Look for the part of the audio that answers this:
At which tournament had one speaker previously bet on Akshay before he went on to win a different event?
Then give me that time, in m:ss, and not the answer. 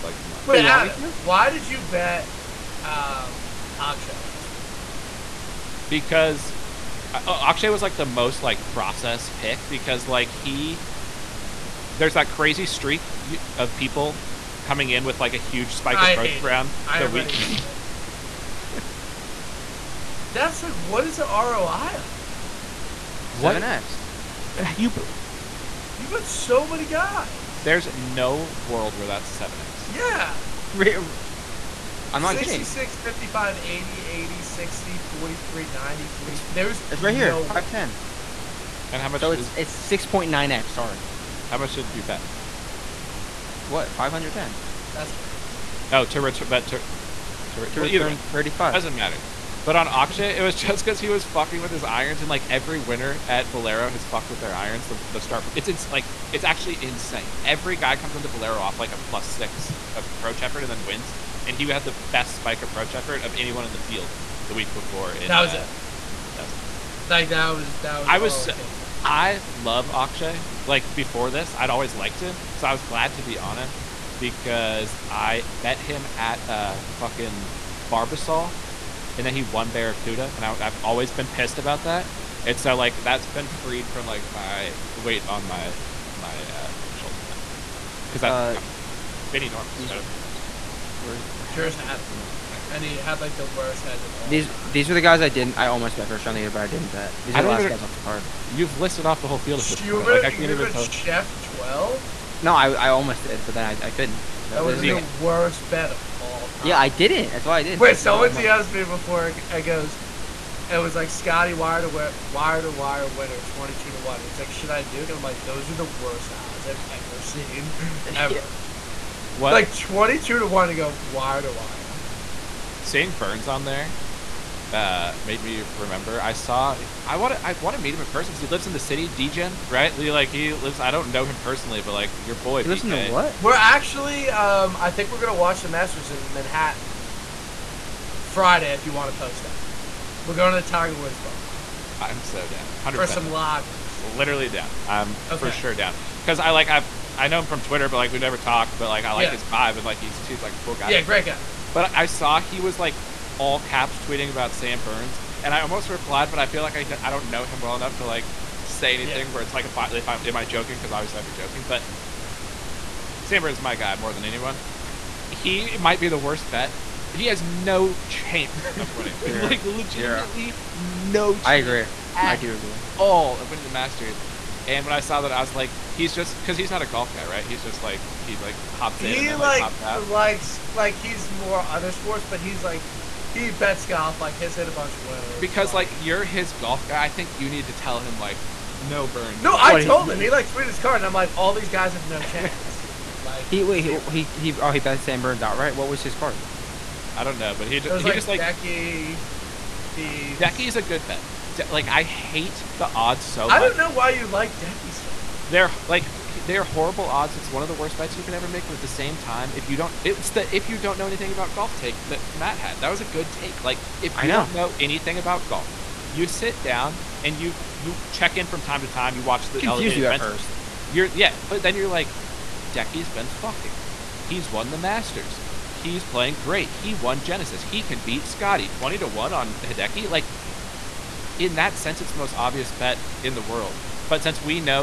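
1:17.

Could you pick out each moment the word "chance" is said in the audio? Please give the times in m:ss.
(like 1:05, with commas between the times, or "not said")
2:48, 3:12.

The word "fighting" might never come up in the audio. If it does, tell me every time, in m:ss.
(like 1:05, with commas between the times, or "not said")
not said.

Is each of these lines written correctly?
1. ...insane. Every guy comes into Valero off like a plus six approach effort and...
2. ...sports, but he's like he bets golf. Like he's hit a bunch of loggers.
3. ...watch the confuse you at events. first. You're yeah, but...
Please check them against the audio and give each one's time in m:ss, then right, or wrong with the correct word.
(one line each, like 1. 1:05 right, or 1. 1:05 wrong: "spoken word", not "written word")
1. 0:56 right
2. 3:01 wrong: "winners", not "loggers"
3. 3:39 right.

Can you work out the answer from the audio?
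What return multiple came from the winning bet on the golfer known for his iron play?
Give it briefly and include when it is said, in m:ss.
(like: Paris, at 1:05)
6.9x, at 0:39.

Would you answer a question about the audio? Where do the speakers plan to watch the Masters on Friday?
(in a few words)
The Tiger Woods bar.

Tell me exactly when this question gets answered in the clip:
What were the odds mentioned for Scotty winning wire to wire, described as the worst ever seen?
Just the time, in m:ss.
1:53.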